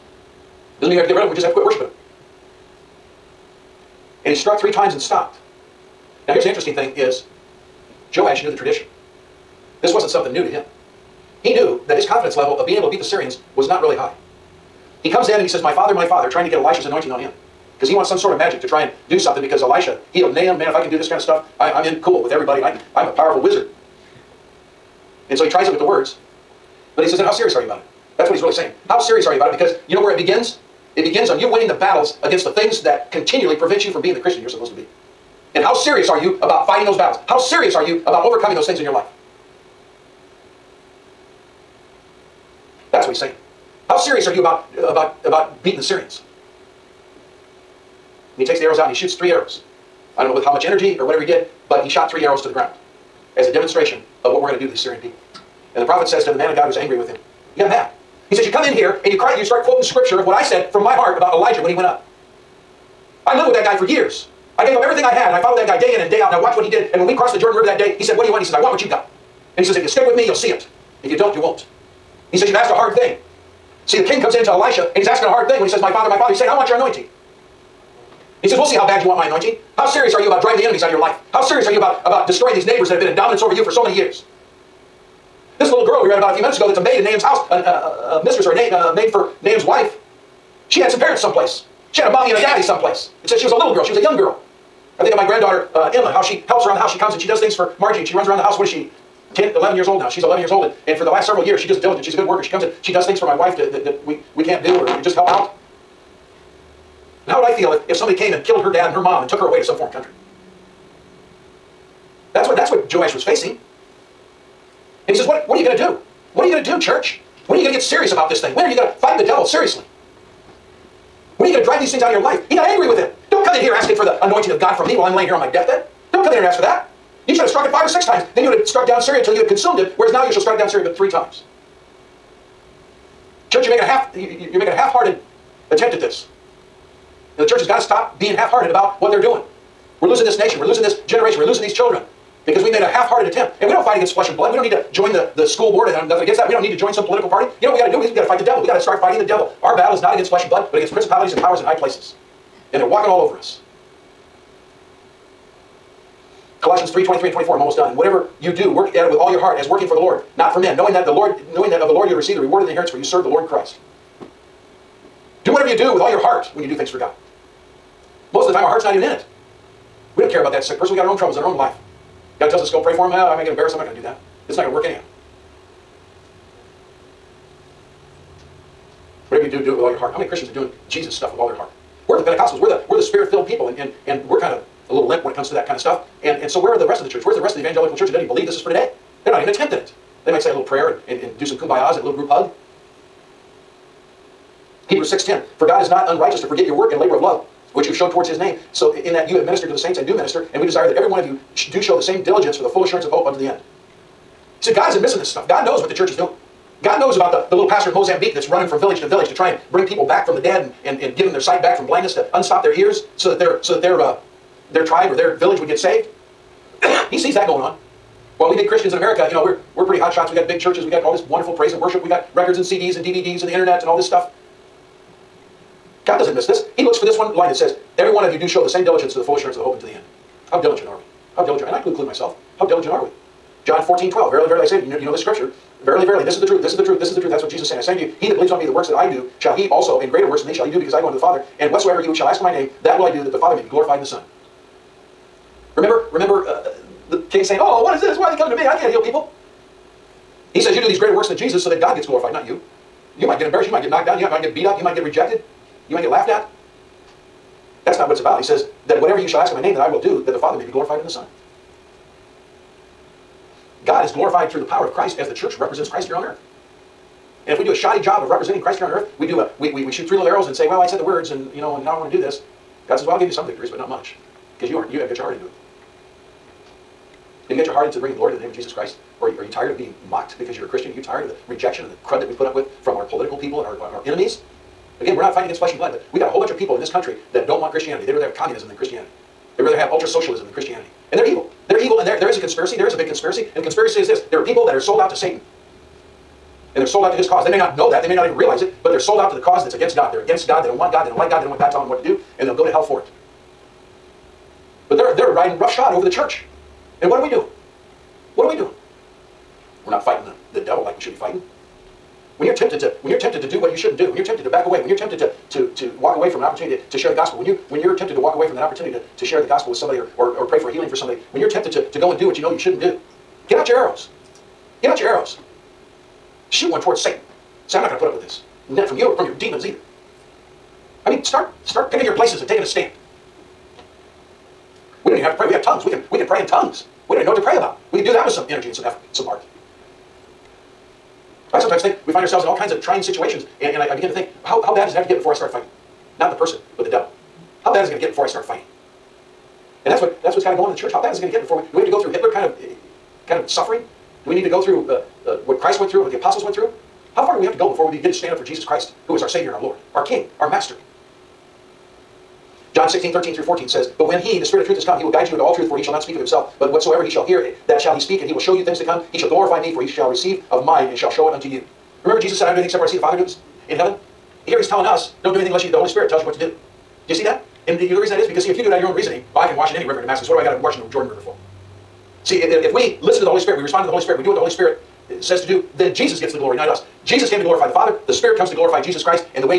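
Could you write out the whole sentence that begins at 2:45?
Do whatever you do with all your heart when you do things for God.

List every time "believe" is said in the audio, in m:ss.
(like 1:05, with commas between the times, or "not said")
3:08, 3:58.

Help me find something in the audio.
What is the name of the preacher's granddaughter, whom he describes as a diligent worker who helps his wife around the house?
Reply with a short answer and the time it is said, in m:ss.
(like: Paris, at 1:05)
Emma, at 1:35.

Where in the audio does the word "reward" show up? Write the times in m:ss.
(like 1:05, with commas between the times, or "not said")
2:42.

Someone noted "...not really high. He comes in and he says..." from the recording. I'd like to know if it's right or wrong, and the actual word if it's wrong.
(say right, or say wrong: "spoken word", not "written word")
right.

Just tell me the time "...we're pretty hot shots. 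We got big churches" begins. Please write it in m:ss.
3:39.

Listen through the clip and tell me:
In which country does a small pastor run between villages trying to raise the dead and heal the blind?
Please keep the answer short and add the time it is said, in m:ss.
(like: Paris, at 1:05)
Mozambique, at 3:27.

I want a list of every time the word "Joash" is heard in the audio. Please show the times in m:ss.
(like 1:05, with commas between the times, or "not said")
0:08, 1:52.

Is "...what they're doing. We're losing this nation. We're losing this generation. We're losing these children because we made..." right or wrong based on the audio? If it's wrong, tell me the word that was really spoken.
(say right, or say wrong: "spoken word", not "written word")
right.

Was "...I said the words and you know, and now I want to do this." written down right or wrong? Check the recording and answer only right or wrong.
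right.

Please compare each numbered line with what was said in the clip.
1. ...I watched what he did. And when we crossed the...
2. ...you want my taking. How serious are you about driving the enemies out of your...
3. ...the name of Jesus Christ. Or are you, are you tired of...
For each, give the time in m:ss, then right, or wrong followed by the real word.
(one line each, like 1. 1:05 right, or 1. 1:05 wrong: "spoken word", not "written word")
1. 1:06 right
2. 1:19 wrong: "anointing", not "taking"
3. 4:38 right.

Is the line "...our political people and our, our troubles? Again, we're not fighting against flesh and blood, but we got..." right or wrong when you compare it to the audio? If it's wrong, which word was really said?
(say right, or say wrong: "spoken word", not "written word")
wrong: "enemies", not "troubles".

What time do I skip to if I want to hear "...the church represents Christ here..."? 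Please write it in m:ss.
4:25.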